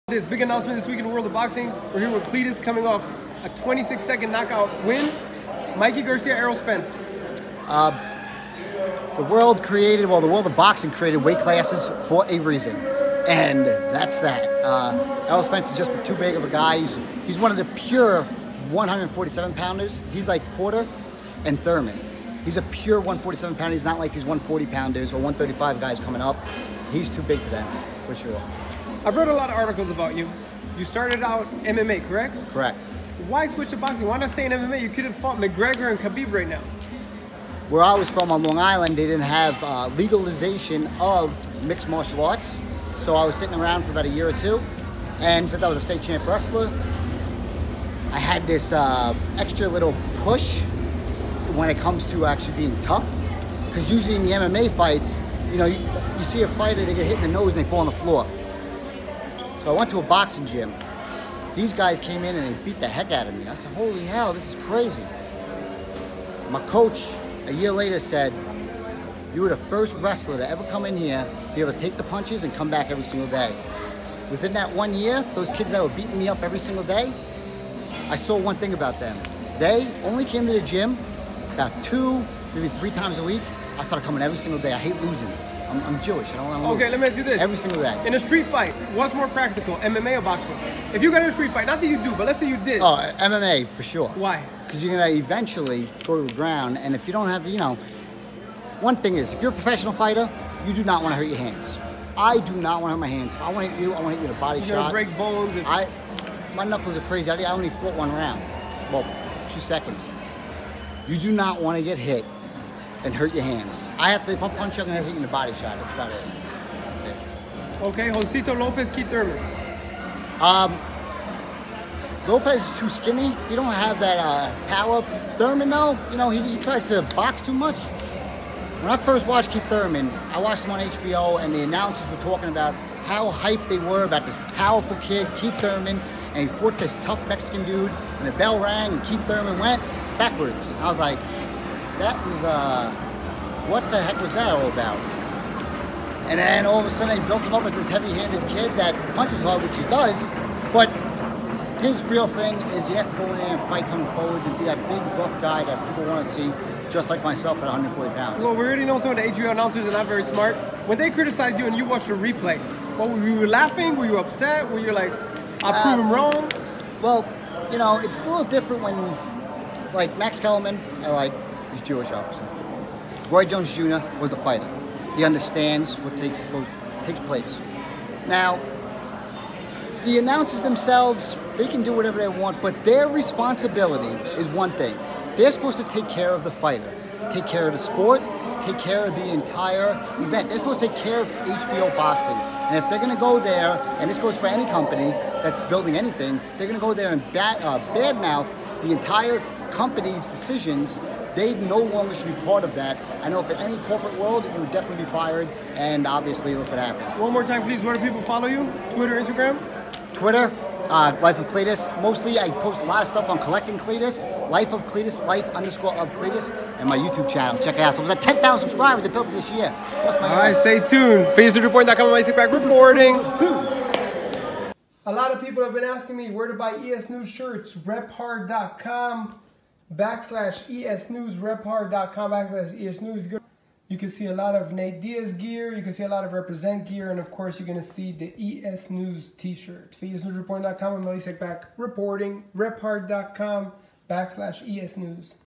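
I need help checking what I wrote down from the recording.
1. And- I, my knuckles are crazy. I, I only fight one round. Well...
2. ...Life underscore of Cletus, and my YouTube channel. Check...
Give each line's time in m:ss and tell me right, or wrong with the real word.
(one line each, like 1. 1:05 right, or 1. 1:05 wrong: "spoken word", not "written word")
1. 1:45 wrong: "fought", not "fight"
2. 3:35 right.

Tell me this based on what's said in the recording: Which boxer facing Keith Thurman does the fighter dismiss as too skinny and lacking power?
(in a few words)
Josesito Lopez.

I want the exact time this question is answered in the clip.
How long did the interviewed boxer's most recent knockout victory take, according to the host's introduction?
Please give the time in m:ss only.
0:03.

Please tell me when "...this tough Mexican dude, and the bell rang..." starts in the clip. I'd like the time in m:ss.
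2:16.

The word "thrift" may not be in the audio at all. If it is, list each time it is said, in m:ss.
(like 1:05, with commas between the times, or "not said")
not said.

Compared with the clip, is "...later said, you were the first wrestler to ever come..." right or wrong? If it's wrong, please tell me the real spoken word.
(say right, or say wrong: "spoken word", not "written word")
right.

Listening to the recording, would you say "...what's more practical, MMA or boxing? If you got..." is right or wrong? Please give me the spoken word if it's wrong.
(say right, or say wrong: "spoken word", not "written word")
right.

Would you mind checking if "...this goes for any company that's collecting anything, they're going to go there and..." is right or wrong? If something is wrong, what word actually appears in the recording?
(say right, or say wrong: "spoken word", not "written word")
wrong: "building", not "collecting".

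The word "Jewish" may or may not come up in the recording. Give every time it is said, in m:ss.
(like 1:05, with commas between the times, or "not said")
1:26, 2:51.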